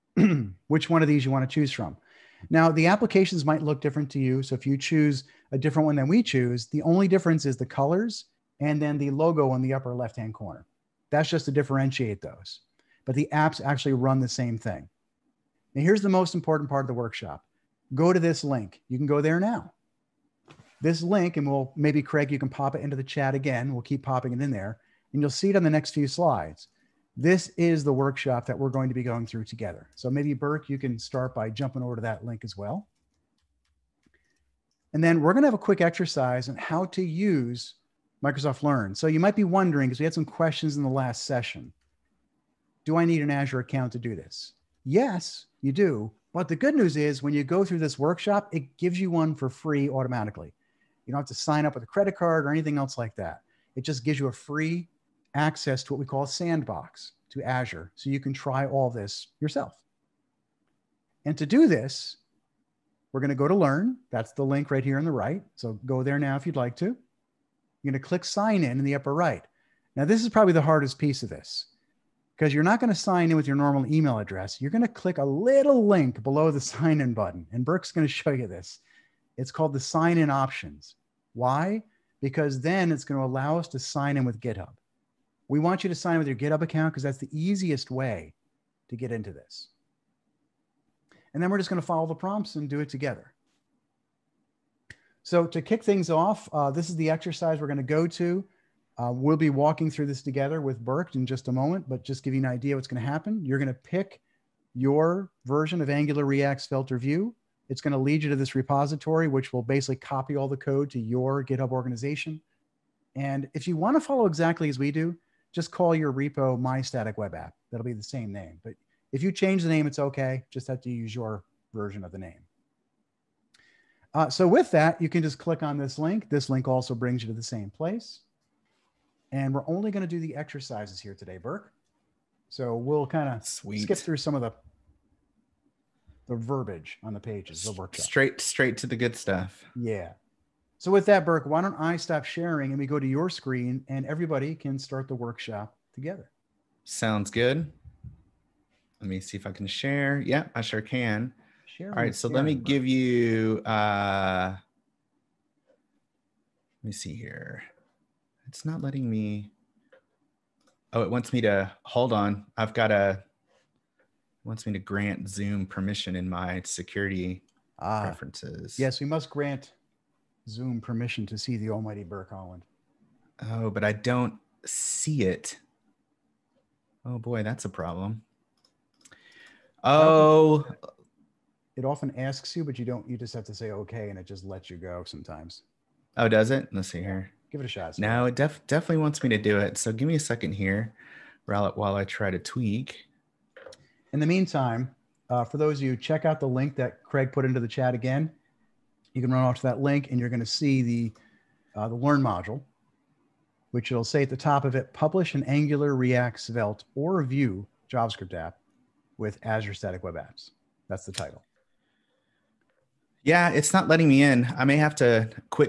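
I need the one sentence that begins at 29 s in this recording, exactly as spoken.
So maybe, Burke, you can start by jumping over to that link as well.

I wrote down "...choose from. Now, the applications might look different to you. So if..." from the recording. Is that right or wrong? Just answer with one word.
right.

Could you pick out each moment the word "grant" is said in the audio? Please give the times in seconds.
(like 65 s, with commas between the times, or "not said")
164 s, 169 s.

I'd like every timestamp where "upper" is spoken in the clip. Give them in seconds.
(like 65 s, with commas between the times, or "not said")
9 s, 68 s.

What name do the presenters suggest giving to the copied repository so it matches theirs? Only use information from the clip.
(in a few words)
My Static Web App.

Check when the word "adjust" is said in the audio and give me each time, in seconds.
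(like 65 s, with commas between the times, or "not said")
not said.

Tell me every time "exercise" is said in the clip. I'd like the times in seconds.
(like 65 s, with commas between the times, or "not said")
35 s, 97 s, 130 s.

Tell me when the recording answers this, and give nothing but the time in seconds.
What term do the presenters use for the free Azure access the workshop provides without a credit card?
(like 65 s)
56 s.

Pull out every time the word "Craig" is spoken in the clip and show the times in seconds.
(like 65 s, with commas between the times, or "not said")
22 s, 197 s.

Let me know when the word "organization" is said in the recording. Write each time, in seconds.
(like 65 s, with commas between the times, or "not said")
111 s.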